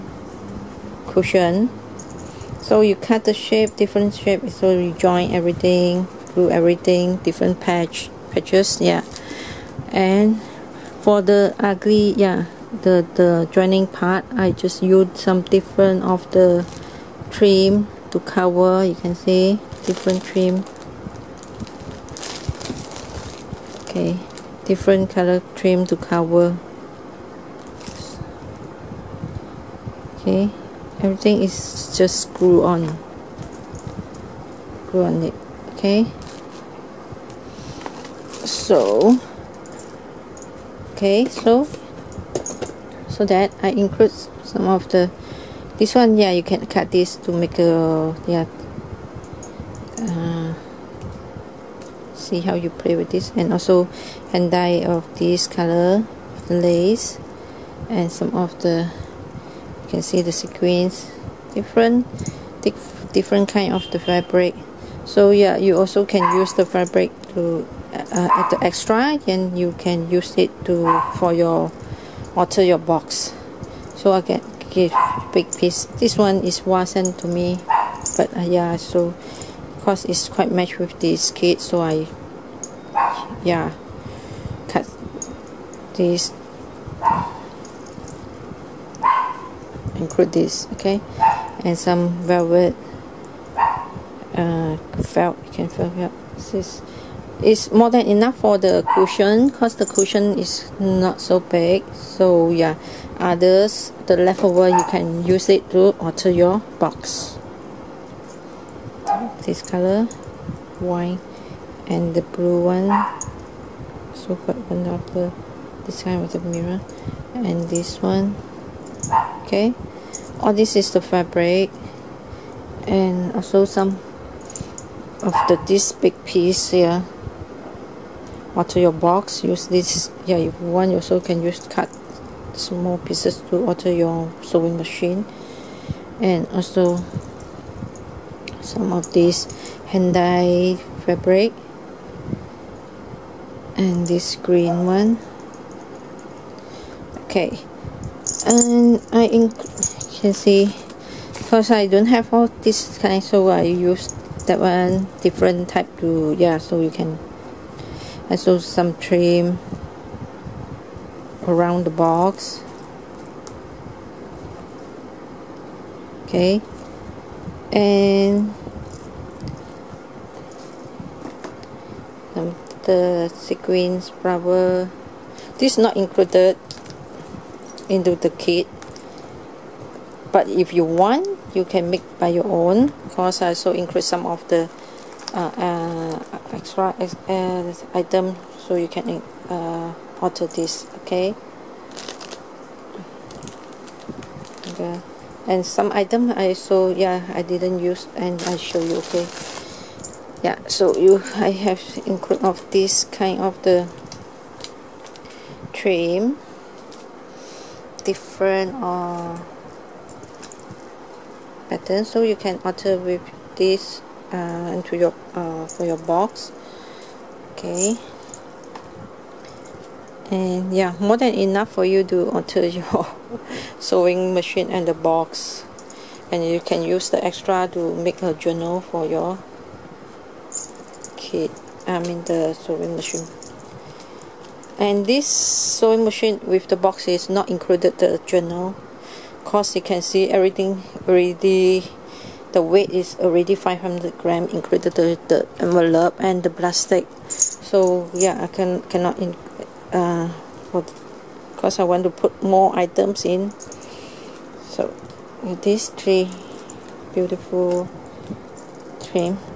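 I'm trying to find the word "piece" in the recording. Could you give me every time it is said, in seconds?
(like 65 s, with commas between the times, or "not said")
75 s, 126 s, 132 s.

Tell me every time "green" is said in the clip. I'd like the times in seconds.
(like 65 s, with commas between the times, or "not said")
144 s.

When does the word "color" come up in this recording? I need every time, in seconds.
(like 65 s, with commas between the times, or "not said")
25 s, 55 s, 109 s.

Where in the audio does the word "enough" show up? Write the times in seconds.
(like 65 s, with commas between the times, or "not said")
98 s, 221 s.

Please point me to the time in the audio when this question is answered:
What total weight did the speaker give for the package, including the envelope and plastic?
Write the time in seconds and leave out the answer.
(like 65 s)
243 s.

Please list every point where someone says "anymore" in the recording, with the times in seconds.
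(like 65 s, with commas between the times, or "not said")
not said.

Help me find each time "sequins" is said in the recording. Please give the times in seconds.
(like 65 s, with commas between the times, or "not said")
60 s, 173 s.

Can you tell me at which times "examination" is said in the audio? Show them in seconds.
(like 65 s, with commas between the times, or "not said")
not said.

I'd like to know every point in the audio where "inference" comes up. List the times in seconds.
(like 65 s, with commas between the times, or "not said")
not said.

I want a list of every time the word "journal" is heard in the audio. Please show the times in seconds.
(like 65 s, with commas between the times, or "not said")
228 s, 238 s.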